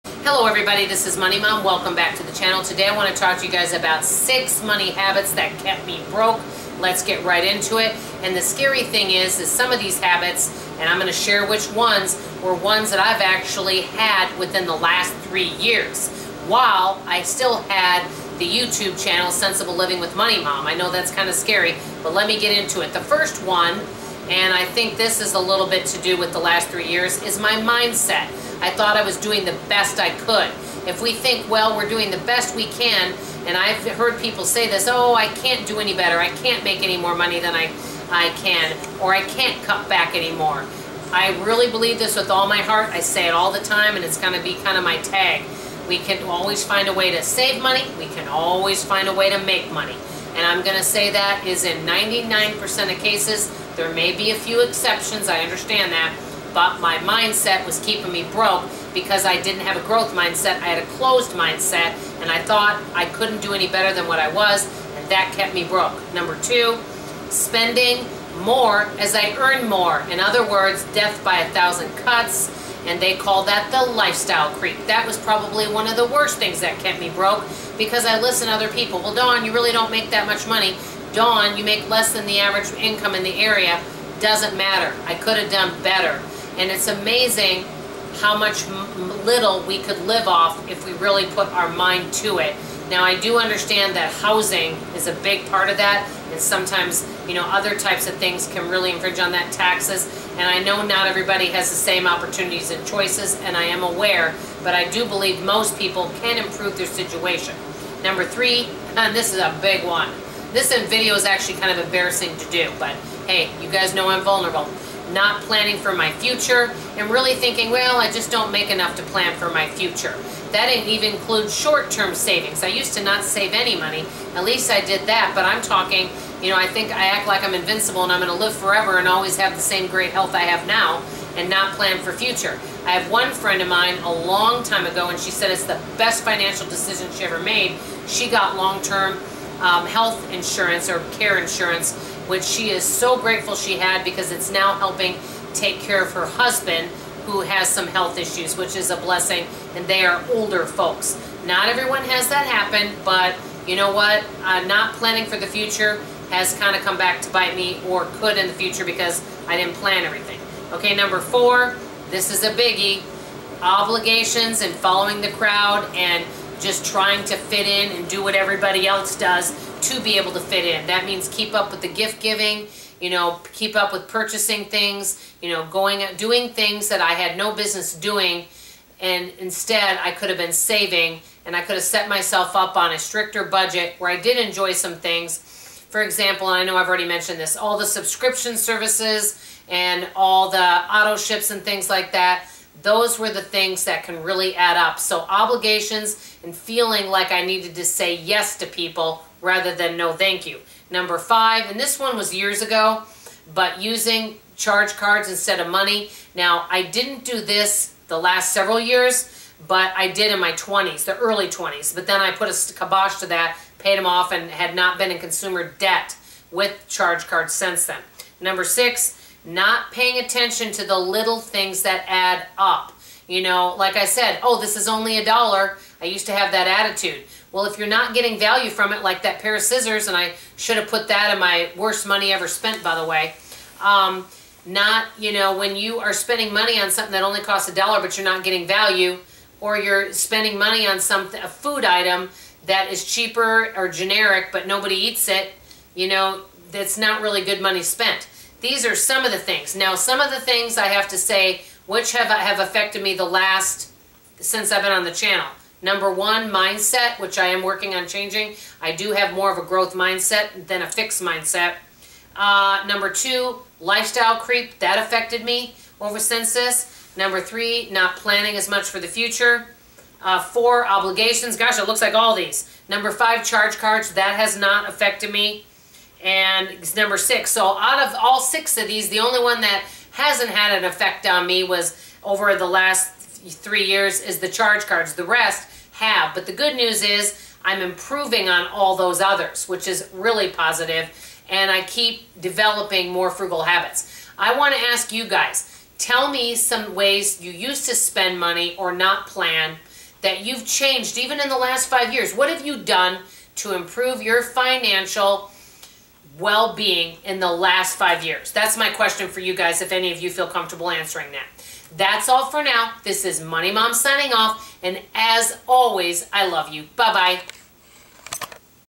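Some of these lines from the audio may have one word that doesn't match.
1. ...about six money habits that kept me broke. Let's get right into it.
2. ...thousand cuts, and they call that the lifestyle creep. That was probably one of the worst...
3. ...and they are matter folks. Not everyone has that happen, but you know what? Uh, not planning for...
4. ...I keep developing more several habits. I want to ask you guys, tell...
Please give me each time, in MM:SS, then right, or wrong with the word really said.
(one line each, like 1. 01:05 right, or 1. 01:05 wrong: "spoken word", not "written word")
1. 00:03 right
2. 01:11 right
3. 02:29 wrong: "older", not "matter"
4. 04:51 wrong: "frugal", not "several".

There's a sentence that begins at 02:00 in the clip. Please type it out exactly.
That didn't even include short-term savings.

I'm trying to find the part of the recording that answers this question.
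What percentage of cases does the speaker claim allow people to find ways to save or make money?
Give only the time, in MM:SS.
00:51.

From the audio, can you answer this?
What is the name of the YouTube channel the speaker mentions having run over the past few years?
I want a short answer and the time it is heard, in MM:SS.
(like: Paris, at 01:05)
Centsible Living with Money Mom, at 00:19.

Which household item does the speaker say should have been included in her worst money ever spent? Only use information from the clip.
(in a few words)
pair of scissors.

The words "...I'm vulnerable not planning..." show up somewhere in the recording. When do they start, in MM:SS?
01:54.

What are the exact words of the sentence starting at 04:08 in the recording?
These are some of the things.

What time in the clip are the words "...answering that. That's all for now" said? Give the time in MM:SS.
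05:10.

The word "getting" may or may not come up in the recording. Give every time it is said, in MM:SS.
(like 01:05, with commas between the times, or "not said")
03:48, 03:58.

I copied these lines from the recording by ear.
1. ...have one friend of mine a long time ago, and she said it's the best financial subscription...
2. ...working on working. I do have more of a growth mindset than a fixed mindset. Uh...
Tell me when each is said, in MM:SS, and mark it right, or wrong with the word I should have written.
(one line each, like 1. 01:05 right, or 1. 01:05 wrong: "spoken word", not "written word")
1. 02:12 wrong: "decision", not "subscription"
2. 04:17 wrong: "changing", not "working".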